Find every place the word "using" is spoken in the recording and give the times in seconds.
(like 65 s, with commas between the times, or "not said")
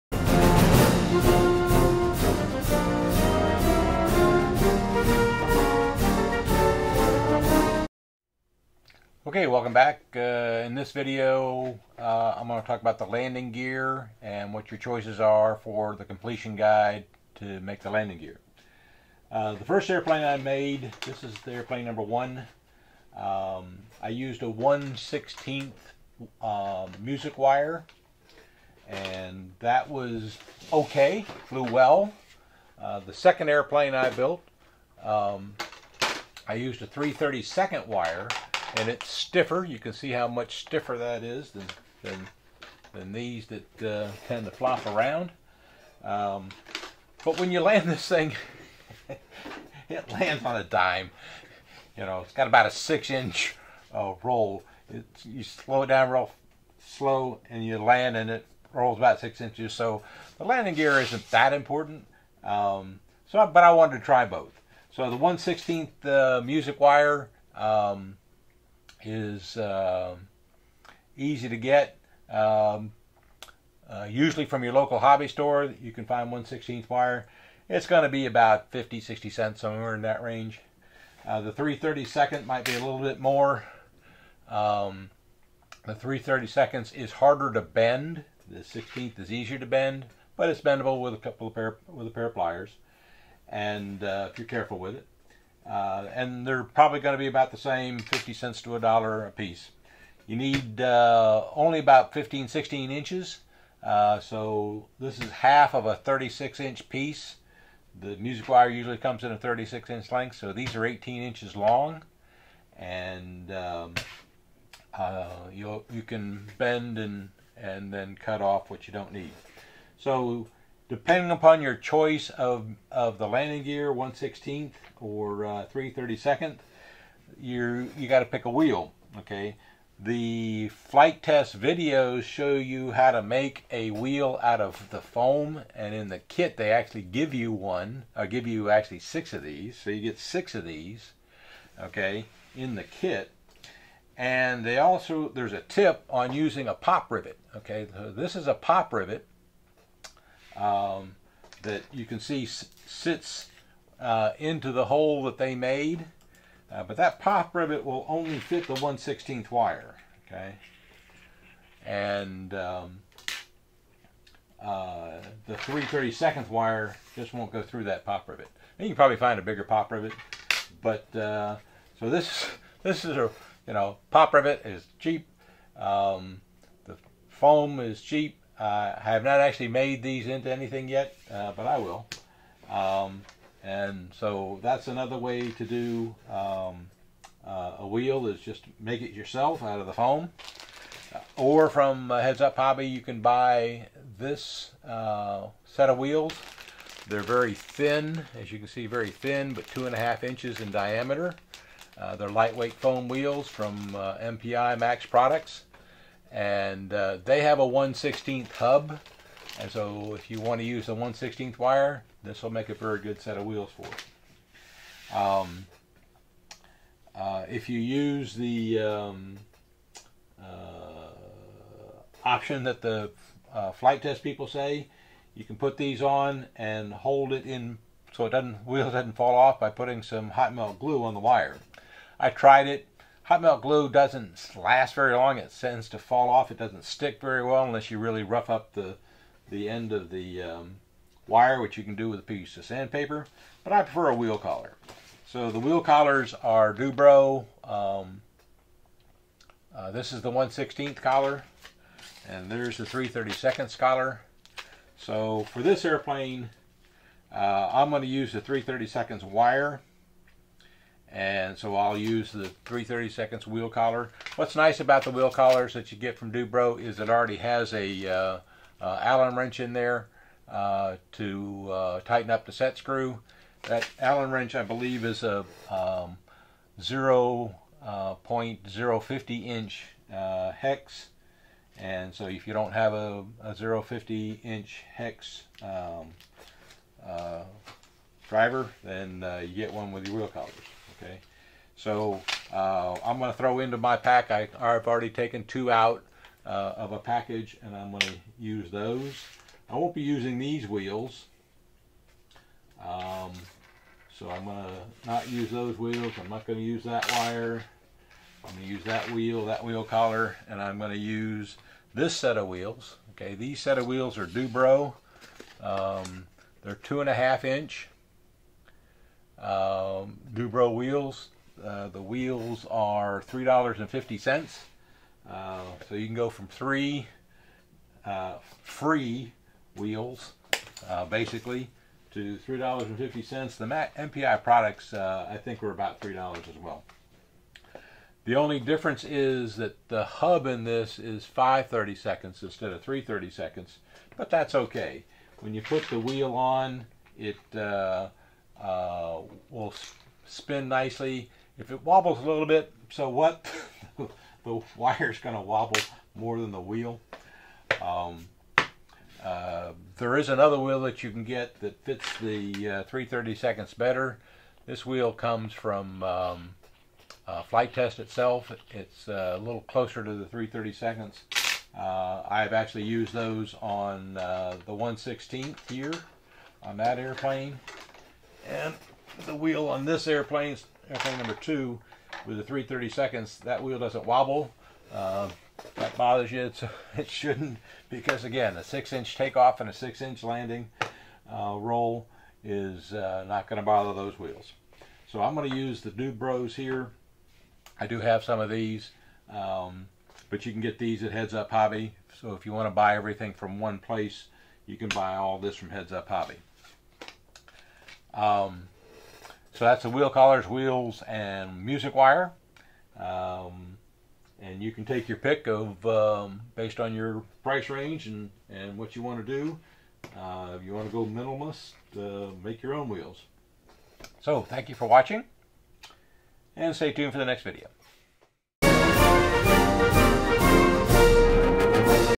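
146 s, 300 s.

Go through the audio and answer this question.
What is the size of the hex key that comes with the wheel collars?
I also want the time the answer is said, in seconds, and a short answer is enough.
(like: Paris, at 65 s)
0.050 inch, at 278 s.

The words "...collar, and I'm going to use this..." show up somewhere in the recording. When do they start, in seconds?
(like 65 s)
309 s.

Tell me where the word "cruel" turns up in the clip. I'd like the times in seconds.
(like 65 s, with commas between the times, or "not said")
not said.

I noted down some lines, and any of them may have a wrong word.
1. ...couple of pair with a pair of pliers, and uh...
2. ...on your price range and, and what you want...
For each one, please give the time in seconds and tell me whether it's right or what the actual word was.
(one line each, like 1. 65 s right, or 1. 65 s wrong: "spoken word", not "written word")
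1. 91 s right
2. 416 s right.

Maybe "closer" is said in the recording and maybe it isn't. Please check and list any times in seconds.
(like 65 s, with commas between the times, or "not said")
369 s.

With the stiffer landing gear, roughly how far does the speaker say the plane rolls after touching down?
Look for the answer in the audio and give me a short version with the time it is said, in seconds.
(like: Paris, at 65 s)
6 inches, at 59 s.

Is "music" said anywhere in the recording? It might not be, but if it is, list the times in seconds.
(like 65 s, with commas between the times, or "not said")
26 s, 66 s, 108 s, 411 s.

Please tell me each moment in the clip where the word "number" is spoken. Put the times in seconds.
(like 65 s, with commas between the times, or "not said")
21 s, 381 s.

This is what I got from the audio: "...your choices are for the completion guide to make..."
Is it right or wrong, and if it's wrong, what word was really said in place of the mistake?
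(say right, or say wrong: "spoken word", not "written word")
right.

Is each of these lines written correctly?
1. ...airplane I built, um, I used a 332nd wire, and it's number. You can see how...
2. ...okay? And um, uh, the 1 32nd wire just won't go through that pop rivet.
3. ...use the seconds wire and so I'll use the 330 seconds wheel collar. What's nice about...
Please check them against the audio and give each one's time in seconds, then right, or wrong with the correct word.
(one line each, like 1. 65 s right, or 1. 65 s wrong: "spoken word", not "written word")
1. 33 s wrong: "stiffer", not "number"
2. 160 s wrong: "3", not "1"
3. 258 s right.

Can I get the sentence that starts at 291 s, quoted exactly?
Okay, so uh, I'm going to throw into my pack.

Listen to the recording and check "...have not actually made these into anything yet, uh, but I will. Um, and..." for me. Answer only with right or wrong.
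right.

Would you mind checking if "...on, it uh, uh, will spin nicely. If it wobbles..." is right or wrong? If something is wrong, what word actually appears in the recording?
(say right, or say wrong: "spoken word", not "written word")
right.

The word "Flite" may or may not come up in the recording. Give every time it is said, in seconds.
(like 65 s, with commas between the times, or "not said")
130 s, 223 s, 367 s.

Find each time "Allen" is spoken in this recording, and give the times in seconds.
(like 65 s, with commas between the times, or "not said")
269 s, 273 s.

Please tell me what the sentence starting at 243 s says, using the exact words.
But I prefer a wheel collar.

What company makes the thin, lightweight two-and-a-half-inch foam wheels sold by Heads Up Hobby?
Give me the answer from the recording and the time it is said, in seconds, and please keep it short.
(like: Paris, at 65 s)
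MPI Max Products, at 203 s.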